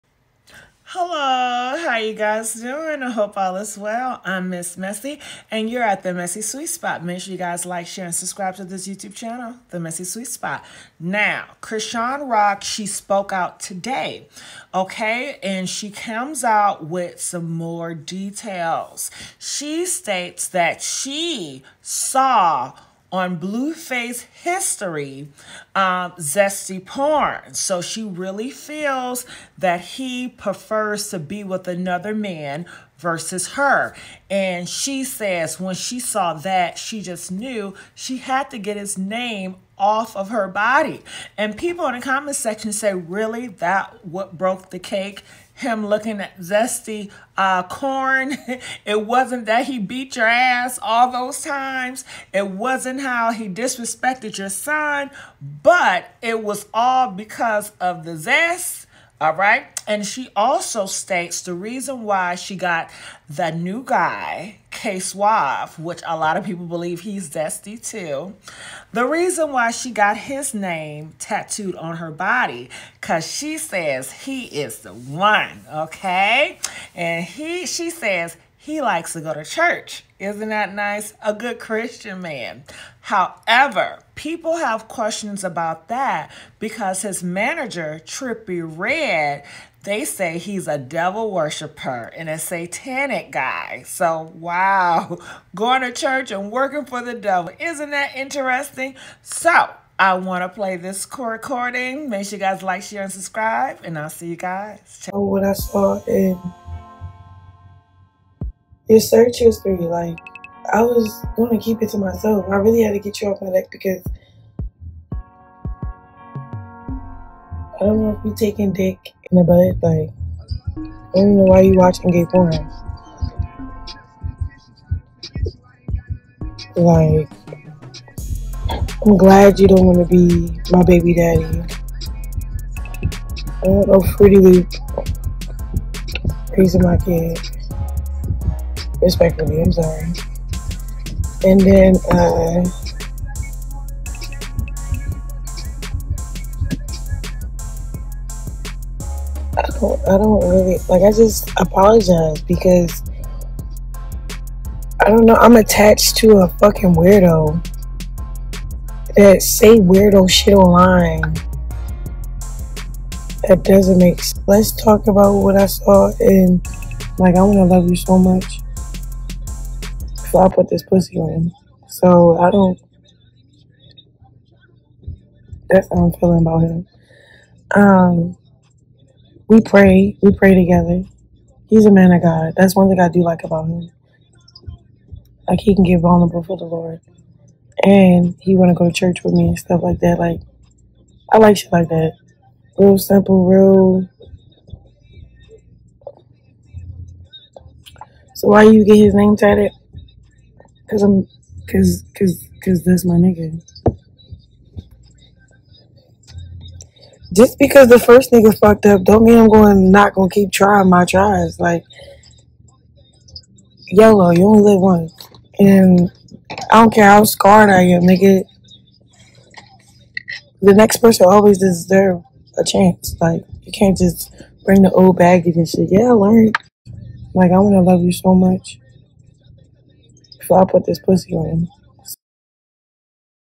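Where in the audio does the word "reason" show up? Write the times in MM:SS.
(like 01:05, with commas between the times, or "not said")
01:01, 01:09.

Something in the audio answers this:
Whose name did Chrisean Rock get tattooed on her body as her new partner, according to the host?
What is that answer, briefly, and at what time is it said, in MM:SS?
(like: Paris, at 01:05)
K Suave, at 01:04.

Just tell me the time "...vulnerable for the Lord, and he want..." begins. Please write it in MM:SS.
03:05.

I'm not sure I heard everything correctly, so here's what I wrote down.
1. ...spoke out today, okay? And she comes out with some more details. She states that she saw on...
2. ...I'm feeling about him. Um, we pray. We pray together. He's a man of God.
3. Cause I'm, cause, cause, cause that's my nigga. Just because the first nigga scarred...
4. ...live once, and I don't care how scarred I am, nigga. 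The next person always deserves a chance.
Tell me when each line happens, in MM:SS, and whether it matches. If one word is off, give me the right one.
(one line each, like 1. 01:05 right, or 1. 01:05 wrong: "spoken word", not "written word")
1. 00:12 right
2. 02:56 right
3. 03:20 wrong: "fucked", not "scarred"
4. 03:34 right.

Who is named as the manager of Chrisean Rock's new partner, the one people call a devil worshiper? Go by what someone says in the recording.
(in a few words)
Trippy Red.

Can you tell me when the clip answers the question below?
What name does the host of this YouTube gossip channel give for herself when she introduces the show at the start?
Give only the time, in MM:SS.
00:04.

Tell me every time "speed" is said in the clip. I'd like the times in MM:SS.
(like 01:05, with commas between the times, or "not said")
not said.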